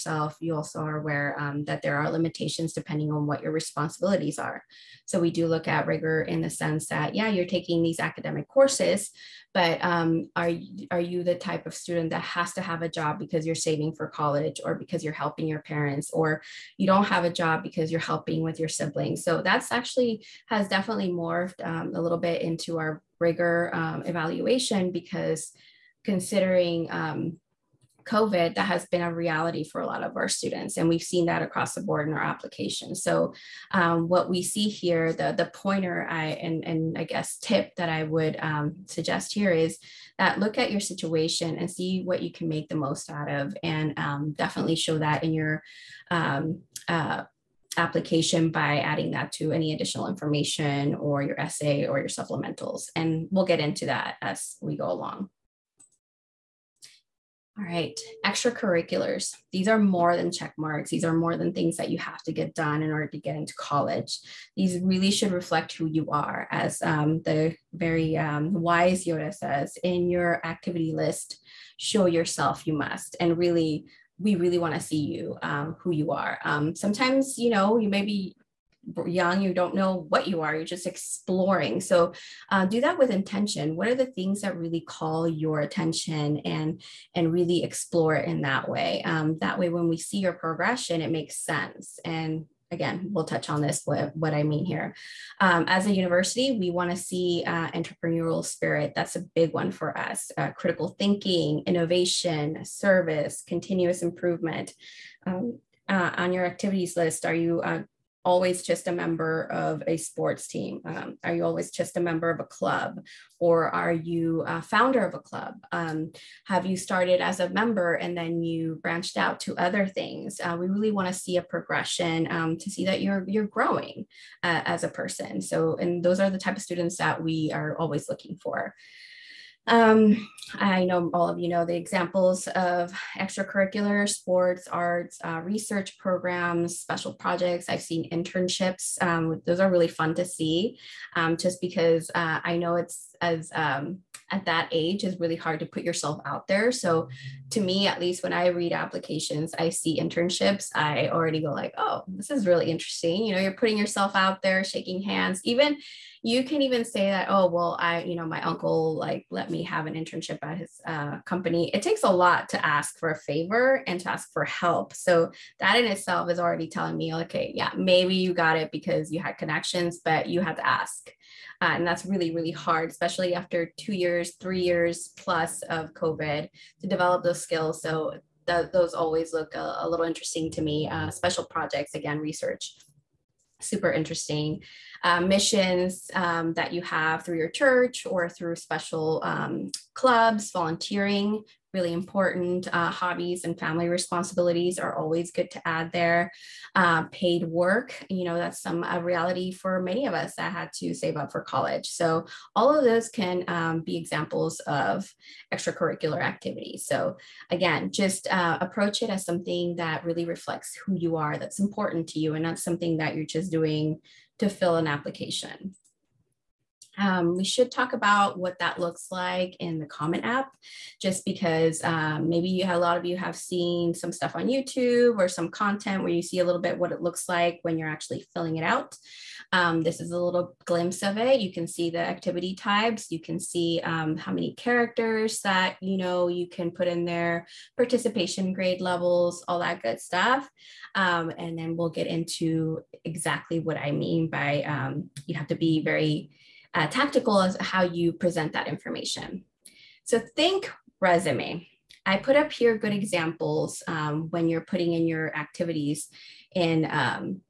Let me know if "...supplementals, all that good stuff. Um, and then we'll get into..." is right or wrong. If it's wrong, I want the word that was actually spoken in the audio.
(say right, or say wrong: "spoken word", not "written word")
wrong: "levels", not "supplementals".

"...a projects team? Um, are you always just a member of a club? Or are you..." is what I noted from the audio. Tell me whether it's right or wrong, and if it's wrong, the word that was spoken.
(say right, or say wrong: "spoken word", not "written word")
wrong: "sports", not "projects".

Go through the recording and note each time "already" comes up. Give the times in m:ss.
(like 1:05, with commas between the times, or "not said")
2:31, 2:46.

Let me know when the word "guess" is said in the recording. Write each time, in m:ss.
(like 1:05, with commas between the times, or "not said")
0:37.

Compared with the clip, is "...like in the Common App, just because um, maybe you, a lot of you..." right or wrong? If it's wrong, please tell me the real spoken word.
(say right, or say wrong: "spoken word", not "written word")
right.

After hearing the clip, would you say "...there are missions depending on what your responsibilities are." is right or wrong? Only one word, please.
wrong.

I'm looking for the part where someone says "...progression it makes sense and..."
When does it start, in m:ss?
1:30.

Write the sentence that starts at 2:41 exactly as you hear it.
It takes a lot to ask for a favor and to ask for help.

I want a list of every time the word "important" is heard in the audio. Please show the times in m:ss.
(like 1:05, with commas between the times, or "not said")
3:11, 3:31.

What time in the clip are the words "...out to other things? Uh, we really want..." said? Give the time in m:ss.
1:59.